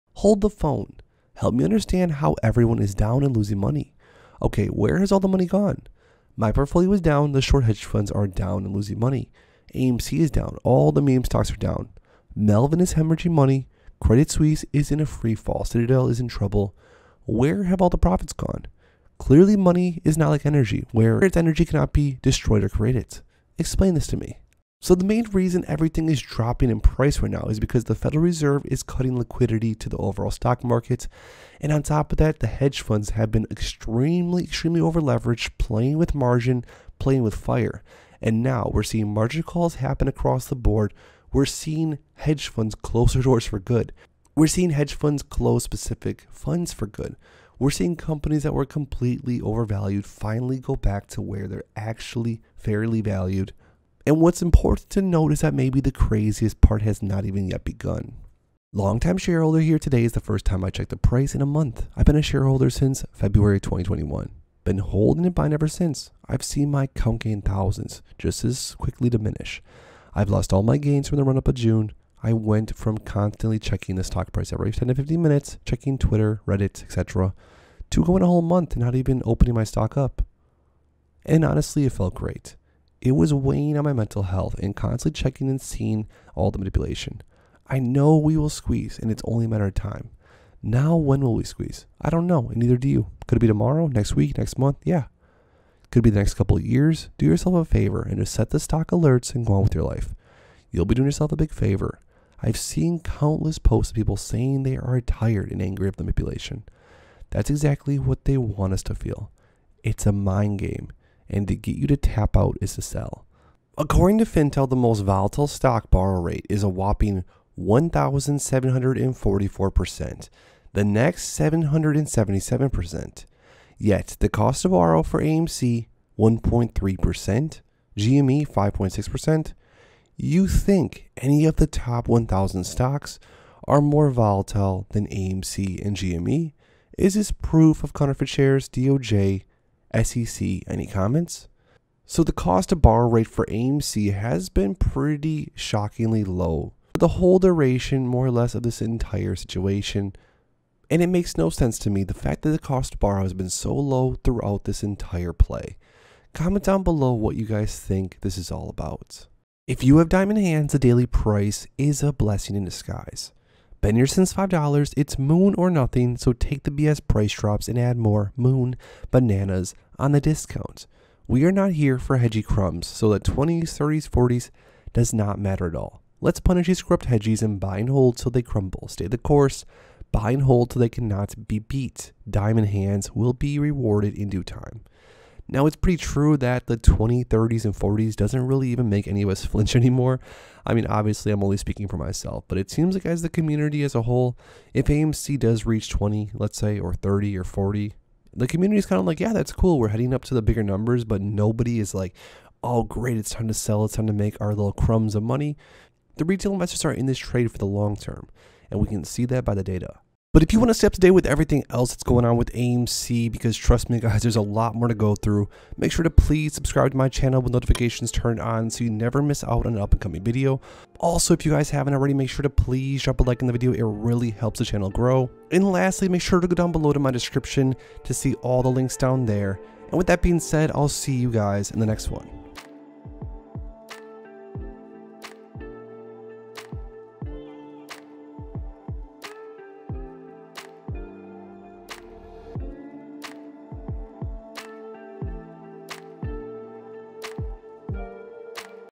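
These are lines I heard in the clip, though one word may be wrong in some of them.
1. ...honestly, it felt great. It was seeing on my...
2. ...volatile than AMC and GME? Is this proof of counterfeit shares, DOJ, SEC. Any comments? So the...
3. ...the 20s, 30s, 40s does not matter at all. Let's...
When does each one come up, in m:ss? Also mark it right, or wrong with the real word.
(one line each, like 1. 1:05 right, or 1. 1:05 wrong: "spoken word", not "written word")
1. 1:21 wrong: "weighing", not "seeing"
2. 2:14 right
3. 2:53 right.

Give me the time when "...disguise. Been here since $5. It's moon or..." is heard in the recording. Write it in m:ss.
2:42.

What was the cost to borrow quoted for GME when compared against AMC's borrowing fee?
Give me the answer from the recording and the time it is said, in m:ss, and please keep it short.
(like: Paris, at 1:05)
5.6%, at 2:08.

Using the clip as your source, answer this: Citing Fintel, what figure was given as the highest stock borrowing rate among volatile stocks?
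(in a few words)
1,744%.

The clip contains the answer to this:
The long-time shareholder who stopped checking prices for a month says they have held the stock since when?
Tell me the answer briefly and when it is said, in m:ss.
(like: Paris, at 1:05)
February 2021, at 1:03.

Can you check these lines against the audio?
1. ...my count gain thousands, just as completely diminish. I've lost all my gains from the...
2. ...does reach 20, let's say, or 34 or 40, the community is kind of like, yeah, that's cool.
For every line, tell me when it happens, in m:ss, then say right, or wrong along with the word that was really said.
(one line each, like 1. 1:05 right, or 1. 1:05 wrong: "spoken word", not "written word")
1. 1:06 wrong: "quickly", not "completely"
2. 3:15 wrong: "30", not "34".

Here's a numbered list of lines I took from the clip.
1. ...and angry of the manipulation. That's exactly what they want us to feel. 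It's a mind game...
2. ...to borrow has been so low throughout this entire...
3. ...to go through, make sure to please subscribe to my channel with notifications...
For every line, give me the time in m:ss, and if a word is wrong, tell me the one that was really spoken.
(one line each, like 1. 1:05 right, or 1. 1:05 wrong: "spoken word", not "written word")
1. 1:45 right
2. 2:32 right
3. 3:34 right.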